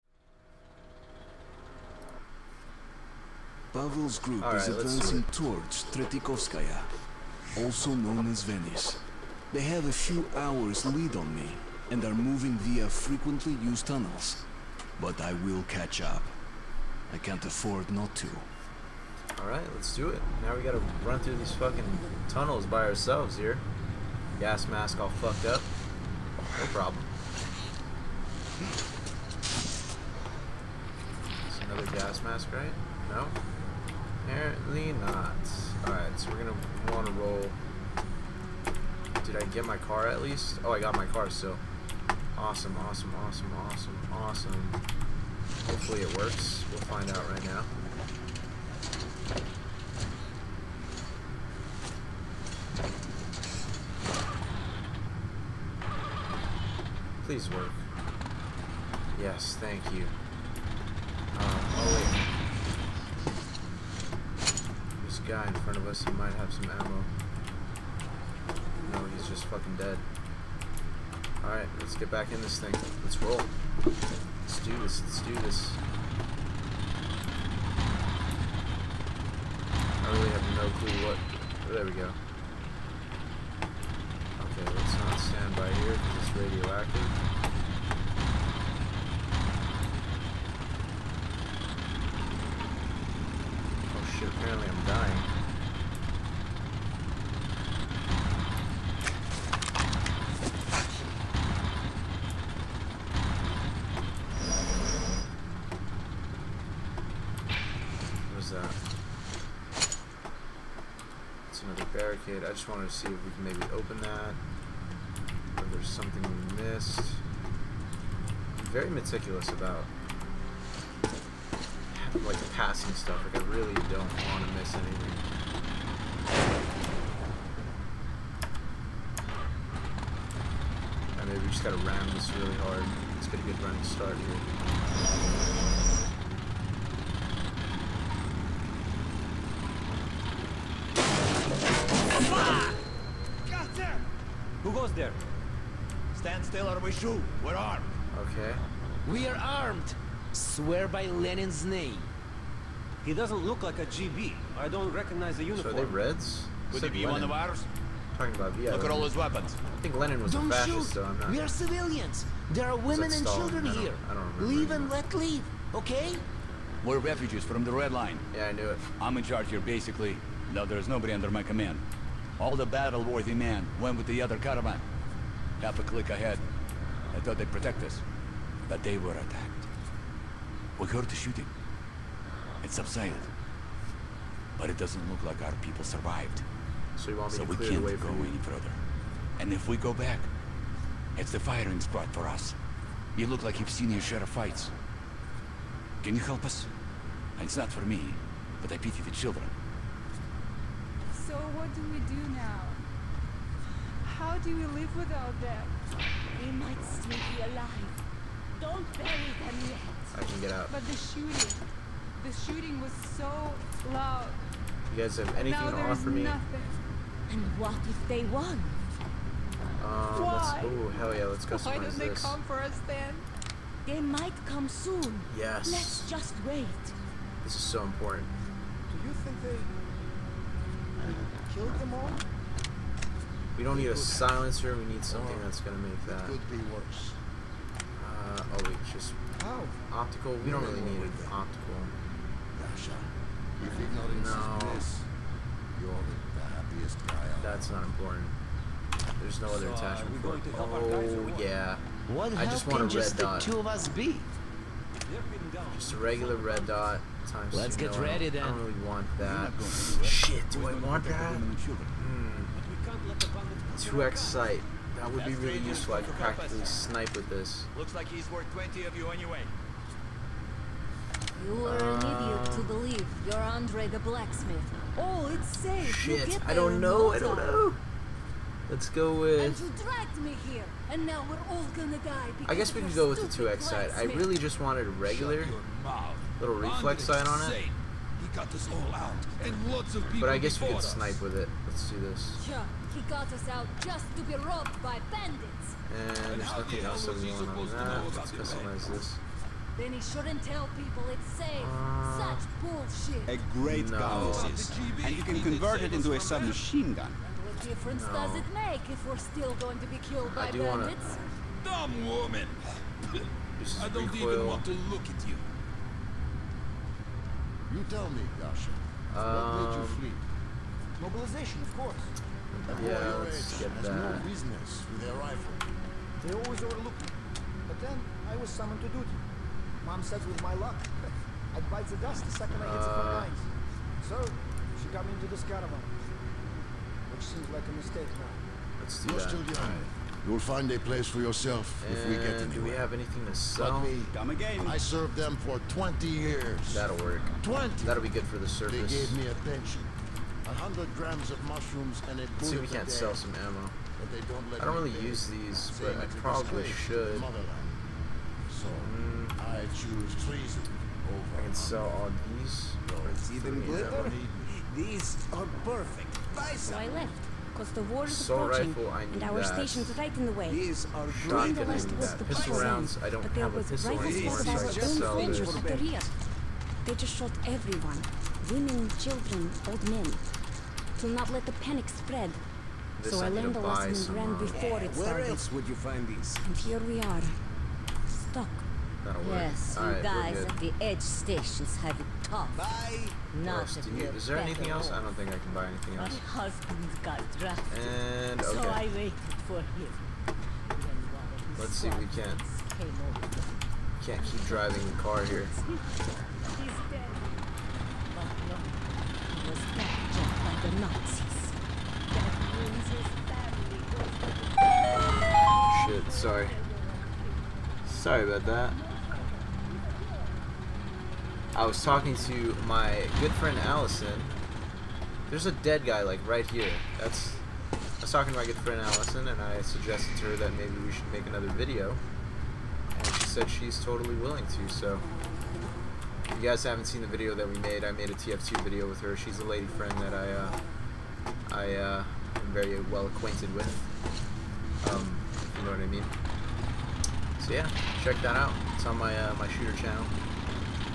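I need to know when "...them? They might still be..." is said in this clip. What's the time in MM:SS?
03:25.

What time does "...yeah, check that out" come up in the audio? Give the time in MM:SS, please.
07:27.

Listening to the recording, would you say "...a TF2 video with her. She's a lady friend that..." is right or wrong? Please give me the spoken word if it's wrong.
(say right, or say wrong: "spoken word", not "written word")
right.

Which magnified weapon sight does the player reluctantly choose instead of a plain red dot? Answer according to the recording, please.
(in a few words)
2x sight.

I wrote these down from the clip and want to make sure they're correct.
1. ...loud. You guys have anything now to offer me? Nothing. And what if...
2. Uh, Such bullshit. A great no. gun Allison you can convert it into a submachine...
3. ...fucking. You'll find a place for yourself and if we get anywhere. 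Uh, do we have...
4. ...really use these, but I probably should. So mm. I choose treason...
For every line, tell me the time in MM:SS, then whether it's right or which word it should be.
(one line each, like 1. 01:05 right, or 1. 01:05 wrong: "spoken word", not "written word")
1. 03:33 right
2. 05:01 wrong: "And", not "Allison"
3. 05:39 wrong: "young", not "fucking"
4. 05:54 right.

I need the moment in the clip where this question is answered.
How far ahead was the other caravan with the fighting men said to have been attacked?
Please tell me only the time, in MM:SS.
02:55.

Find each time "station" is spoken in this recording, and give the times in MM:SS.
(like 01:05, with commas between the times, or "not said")
06:09, 06:31.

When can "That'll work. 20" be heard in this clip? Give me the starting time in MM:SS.
05:46.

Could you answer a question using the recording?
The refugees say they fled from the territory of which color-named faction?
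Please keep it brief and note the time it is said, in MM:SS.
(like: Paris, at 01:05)
The Red Line, at 02:47.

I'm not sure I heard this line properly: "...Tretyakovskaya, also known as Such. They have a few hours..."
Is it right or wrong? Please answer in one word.
wrong.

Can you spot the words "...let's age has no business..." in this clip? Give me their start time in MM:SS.
05:23.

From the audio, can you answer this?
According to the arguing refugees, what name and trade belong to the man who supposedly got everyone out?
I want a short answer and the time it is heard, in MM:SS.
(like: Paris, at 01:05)
Andre the blacksmith, at 04:33.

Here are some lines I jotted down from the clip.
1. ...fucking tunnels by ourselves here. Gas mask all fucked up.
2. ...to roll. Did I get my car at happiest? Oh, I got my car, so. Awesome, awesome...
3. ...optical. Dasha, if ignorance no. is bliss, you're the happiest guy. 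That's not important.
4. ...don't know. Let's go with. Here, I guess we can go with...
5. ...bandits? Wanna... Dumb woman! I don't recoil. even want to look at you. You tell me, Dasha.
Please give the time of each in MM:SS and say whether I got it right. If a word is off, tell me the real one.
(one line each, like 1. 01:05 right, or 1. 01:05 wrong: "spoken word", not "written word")
1. 00:21 right
2. 00:37 wrong: "least", not "happiest"
3. 04:01 right
4. 04:37 right
5. 05:10 right.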